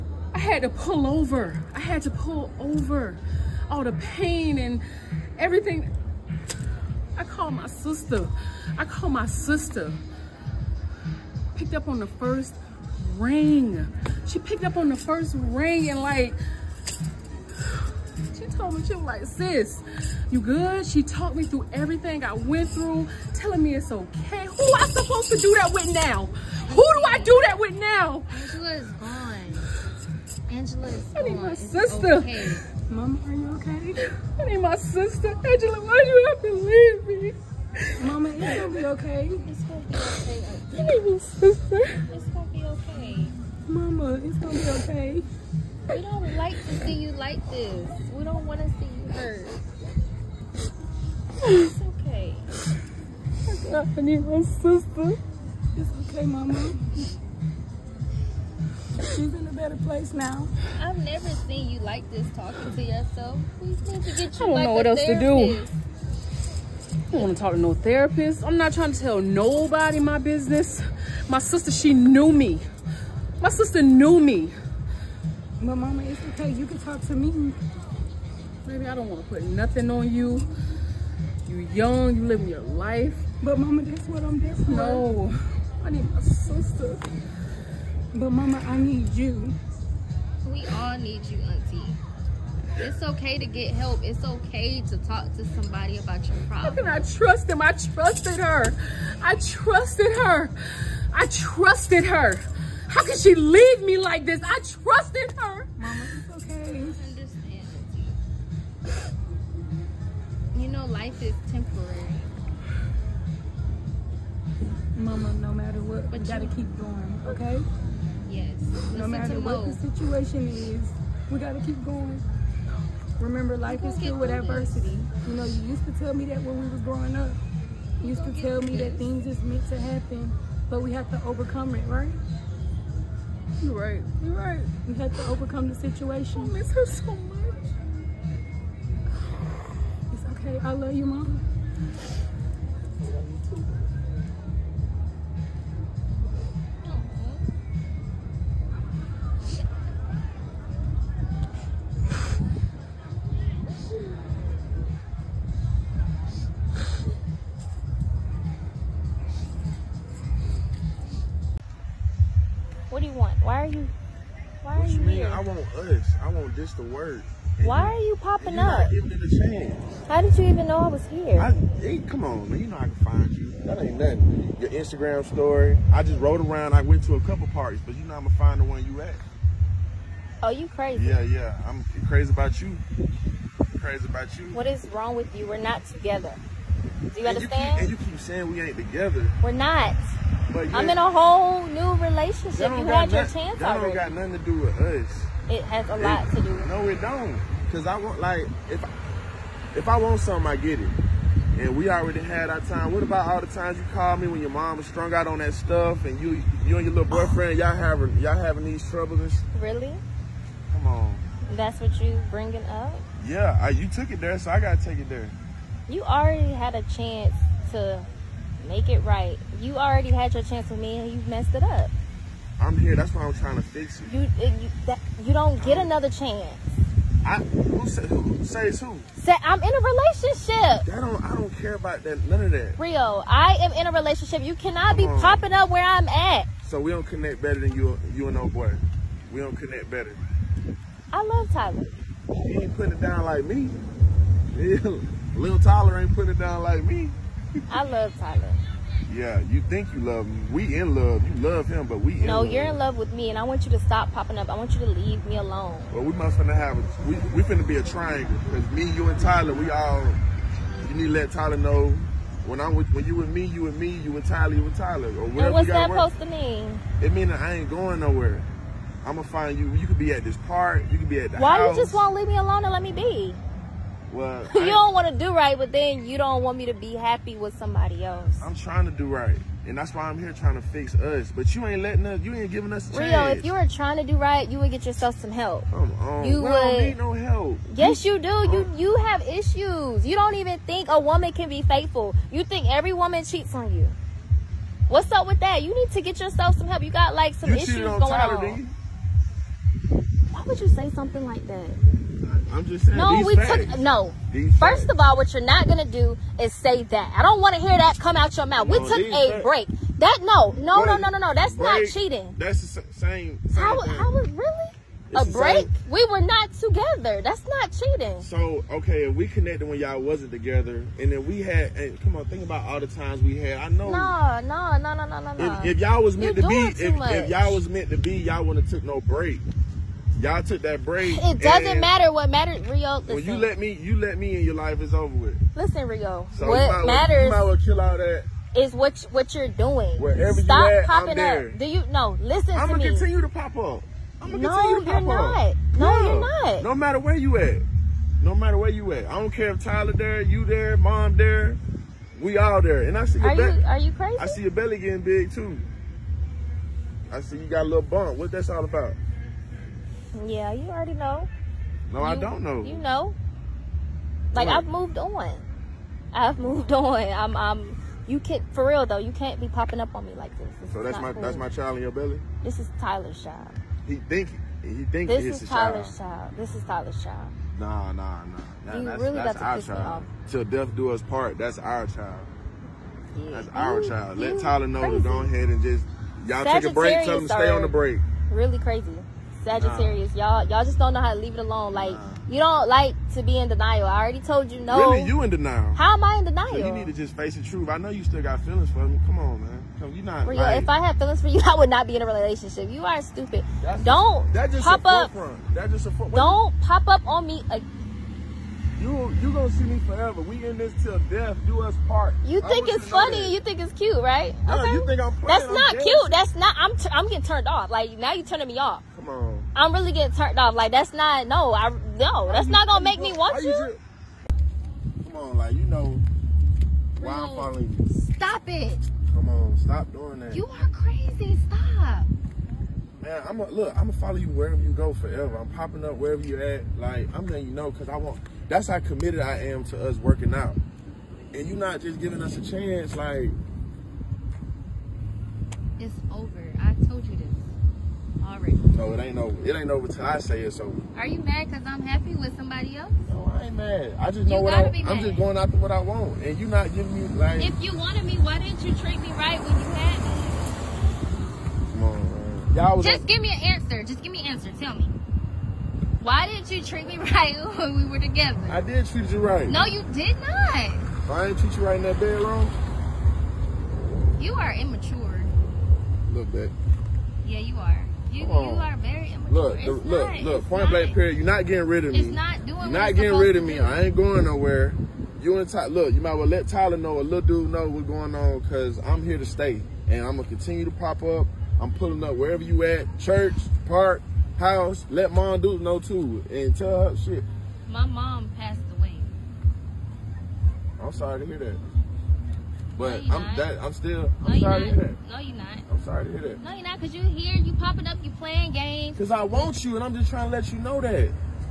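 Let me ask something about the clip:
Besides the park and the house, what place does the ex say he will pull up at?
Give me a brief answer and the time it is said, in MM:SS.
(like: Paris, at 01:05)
church, at 08:12.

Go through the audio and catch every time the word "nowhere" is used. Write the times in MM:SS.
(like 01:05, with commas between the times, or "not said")
04:27, 08:04.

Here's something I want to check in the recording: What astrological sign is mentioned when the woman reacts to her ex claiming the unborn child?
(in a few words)
Sagittarius.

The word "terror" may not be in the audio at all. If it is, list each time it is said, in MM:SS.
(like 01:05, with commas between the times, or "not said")
not said.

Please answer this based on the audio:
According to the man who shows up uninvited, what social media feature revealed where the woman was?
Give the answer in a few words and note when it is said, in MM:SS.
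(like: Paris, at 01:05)
Instagram story, at 02:54.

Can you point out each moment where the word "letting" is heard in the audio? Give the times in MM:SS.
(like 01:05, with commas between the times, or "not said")
04:41, 07:17.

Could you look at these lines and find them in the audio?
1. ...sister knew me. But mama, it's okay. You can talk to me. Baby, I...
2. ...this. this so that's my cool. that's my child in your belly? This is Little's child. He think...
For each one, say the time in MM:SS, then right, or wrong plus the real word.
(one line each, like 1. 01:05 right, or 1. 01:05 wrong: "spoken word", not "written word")
1. 01:13 right
2. 06:10 wrong: "Tyler", not "Little".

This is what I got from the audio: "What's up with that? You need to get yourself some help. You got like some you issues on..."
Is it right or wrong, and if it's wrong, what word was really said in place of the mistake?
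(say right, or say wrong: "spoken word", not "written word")
right.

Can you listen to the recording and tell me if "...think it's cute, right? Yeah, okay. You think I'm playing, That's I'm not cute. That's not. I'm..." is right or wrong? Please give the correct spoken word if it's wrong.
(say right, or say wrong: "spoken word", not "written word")
right.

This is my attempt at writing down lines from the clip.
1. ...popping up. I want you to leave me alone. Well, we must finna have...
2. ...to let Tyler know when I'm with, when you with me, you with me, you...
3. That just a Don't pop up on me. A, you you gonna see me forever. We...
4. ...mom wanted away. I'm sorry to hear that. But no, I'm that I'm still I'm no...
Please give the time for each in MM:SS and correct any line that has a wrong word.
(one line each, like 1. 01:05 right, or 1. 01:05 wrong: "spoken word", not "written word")
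1. 04:14 right
2. 04:21 right
3. 06:45 right
4. 08:17 wrong: "passed", not "wanted".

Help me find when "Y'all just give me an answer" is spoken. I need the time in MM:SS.
07:42.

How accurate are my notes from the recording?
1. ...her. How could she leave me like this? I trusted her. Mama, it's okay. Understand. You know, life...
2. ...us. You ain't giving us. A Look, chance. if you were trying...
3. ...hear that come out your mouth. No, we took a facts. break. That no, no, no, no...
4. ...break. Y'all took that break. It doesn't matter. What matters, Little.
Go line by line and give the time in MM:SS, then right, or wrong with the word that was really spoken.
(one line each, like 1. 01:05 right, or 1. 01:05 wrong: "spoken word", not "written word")
1. 01:42 right
2. 04:42 wrong: "Rio", not "Look"
3. 05:07 right
4. 05:29 wrong: "Rio", not "Little".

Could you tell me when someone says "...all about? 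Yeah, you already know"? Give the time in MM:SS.
05:58.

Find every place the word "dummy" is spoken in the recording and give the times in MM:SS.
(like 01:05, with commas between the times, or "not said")
not said.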